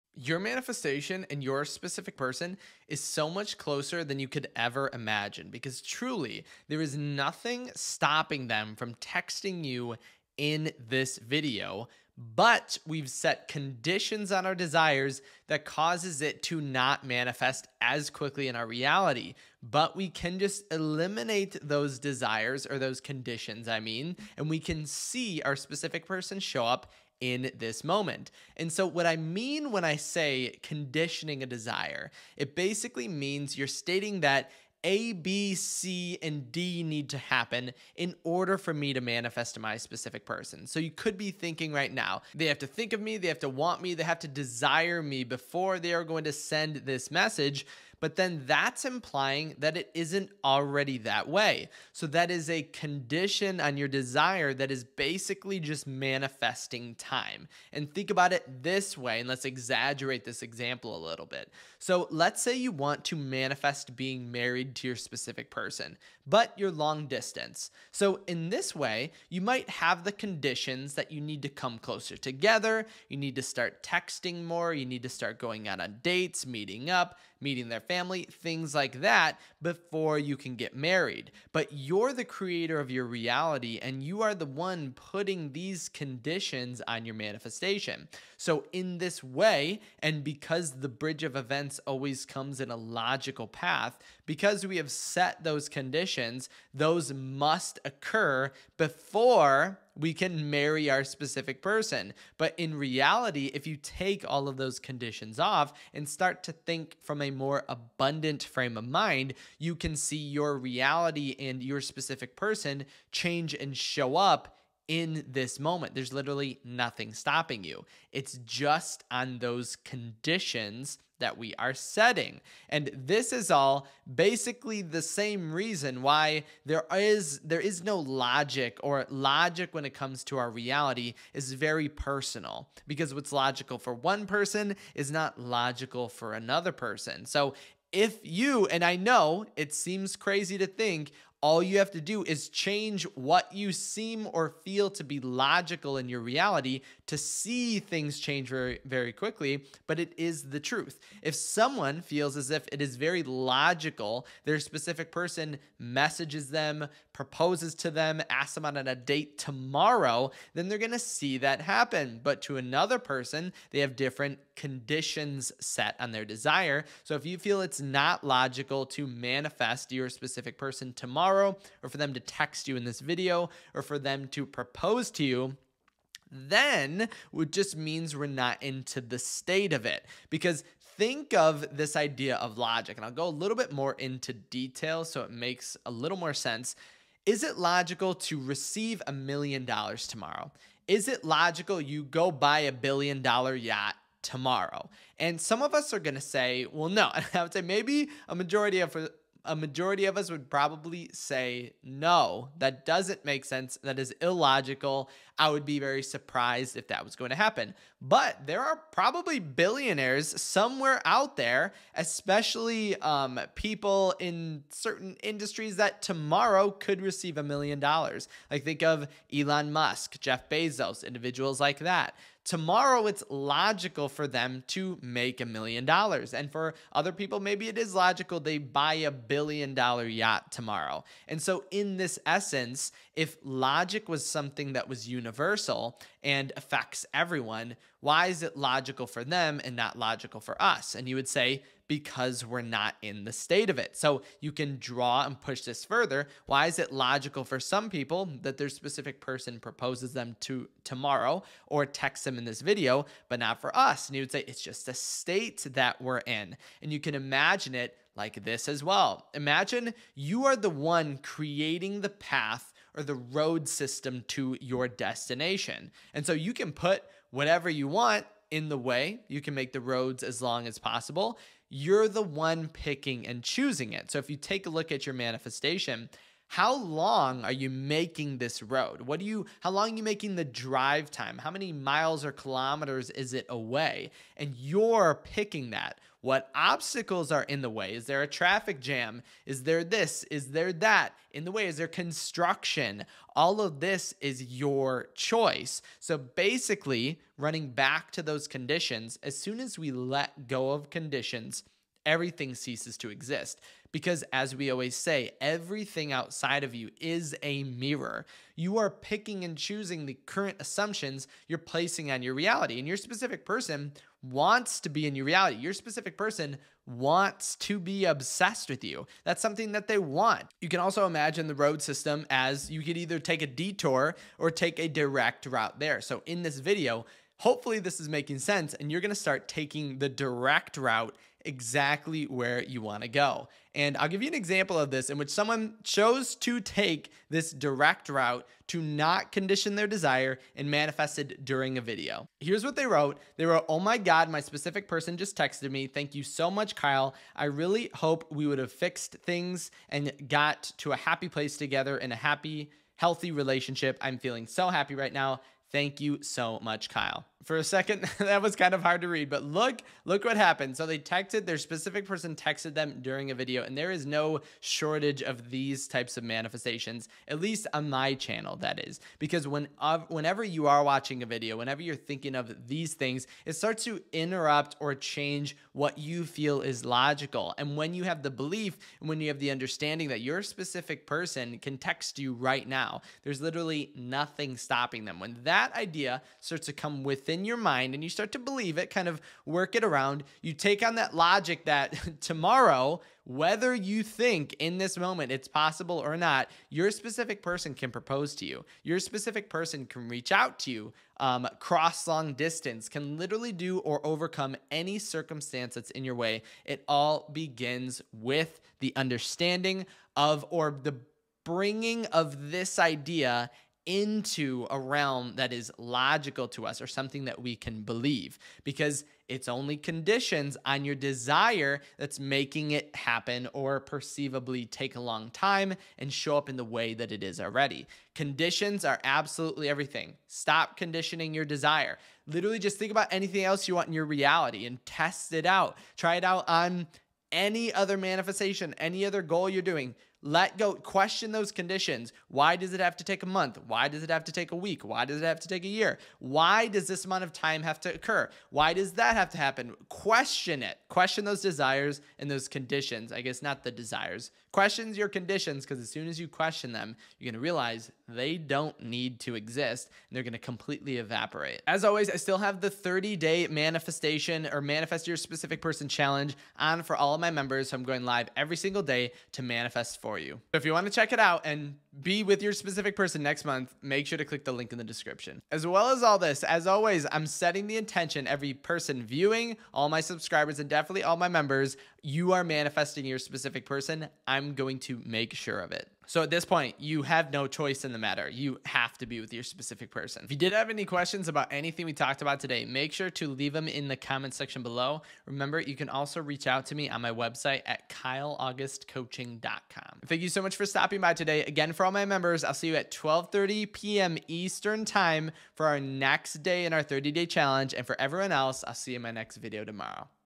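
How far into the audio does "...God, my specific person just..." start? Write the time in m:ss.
5:43.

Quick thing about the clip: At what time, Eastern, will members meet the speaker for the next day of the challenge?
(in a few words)
12:30 p.m.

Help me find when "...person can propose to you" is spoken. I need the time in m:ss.
6:37.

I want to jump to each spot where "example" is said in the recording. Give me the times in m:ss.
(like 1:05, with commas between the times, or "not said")
1:00, 5:34.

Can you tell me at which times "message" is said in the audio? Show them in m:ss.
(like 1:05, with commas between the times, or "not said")
0:47, 2:35.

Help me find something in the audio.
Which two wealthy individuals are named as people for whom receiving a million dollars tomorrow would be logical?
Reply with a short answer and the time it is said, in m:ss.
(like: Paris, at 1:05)
Elon Musk, Jeff Bezos, at 3:39.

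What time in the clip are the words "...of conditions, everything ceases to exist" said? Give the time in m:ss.
5:00.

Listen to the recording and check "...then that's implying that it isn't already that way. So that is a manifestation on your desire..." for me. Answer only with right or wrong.
wrong.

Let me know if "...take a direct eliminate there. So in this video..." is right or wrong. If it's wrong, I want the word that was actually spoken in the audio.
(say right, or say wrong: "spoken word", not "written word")
wrong: "route", not "eliminate".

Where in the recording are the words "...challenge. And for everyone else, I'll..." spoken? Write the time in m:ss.
8:27.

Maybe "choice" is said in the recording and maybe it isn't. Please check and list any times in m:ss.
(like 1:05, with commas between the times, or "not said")
4:55, 8:07.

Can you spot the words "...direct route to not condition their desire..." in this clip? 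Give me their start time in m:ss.
5:37.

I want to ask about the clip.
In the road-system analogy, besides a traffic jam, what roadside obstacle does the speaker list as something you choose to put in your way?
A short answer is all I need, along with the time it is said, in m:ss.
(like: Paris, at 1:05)
construction, at 4:51.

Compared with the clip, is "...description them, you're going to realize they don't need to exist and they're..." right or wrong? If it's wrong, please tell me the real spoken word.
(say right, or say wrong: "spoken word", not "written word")
wrong: "question", not "description".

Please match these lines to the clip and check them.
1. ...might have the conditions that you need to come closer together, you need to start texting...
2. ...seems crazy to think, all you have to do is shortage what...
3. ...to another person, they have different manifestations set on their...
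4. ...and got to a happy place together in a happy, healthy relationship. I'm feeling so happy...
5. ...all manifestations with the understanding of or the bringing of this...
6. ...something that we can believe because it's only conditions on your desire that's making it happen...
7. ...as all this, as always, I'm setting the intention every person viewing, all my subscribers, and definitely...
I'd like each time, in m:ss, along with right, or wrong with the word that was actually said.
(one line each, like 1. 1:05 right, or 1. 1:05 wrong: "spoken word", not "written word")
1. 1:09 right
2. 2:19 wrong: "change", not "shortage"
3. 2:42 wrong: "conditions", not "manifestations"
4. 5:49 right
5. 6:46 wrong: "begins", not "manifestations"
6. 6:56 right
7. 7:55 right.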